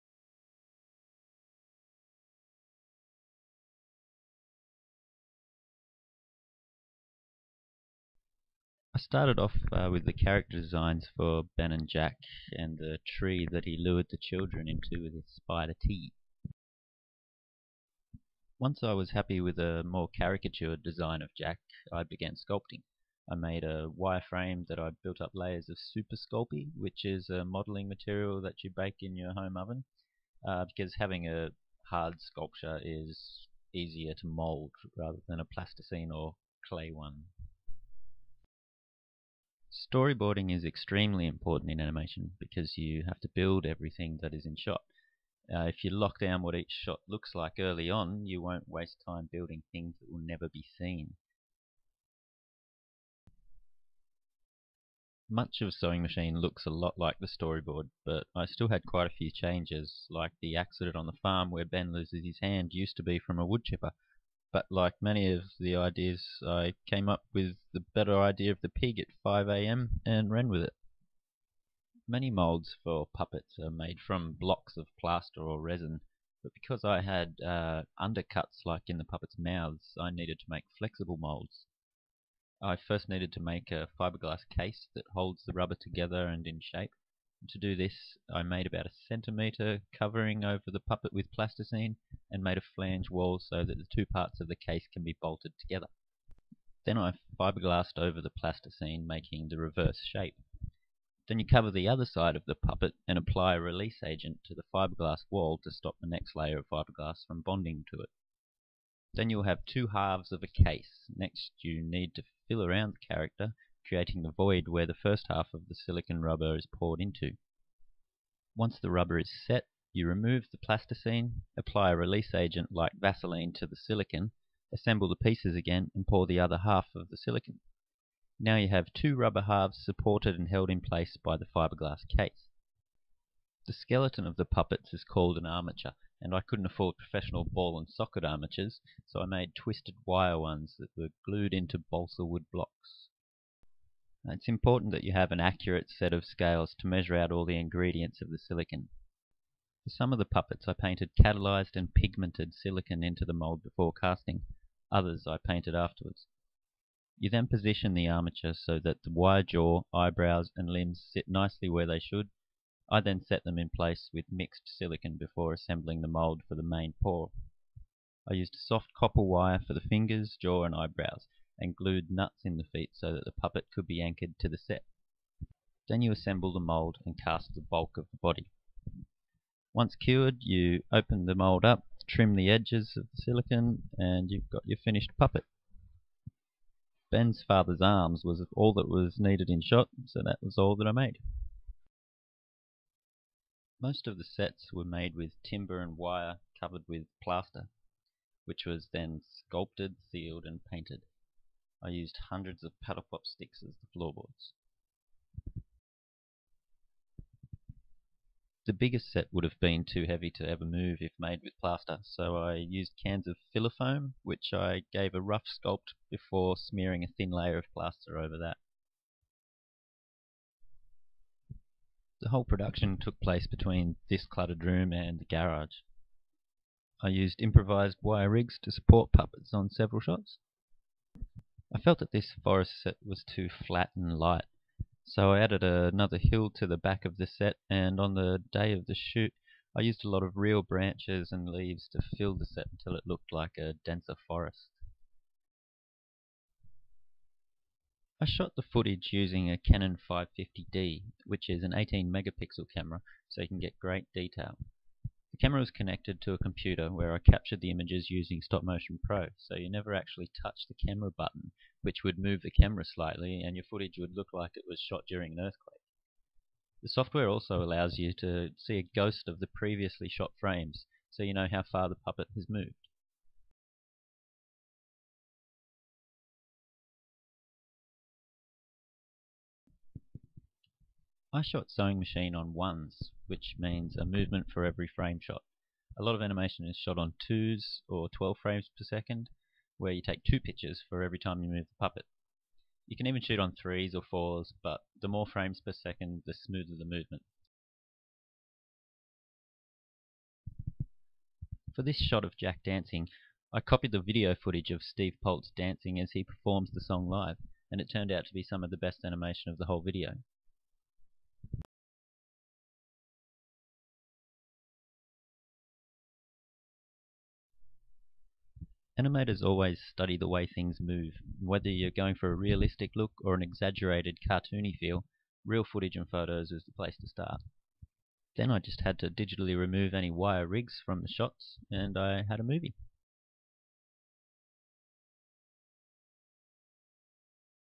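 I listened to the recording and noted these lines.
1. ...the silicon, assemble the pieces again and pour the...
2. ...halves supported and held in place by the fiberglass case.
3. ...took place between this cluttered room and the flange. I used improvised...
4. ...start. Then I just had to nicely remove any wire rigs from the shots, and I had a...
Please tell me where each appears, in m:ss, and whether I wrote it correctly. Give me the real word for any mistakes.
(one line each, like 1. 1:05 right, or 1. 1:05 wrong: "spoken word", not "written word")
1. 2:03 right
2. 2:09 right
3. 3:42 wrong: "garage", not "flange"
4. 5:27 wrong: "digitally", not "nicely".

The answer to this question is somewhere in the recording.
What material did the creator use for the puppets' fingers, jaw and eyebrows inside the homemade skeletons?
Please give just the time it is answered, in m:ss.
2:48.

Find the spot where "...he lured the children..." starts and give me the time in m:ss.
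0:13.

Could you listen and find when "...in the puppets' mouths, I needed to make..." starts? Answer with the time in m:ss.
1:18.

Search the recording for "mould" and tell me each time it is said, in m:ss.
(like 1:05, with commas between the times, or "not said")
0:34, 2:56, 3:01.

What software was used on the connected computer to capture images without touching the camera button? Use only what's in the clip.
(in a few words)
Stop Motion Pro.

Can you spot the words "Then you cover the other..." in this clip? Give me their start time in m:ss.
1:41.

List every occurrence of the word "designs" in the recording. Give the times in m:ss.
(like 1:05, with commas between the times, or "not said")
0:10, 0:20.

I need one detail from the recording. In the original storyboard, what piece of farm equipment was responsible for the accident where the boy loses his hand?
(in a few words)
Wood chipper.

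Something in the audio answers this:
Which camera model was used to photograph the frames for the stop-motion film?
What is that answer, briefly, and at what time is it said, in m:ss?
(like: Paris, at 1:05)
Canon 550D, at 4:09.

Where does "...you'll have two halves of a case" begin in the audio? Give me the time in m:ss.
1:49.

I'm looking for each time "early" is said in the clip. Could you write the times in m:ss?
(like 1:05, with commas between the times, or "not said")
0:47.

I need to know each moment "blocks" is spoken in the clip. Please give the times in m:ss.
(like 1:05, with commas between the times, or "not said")
1:14, 2:22.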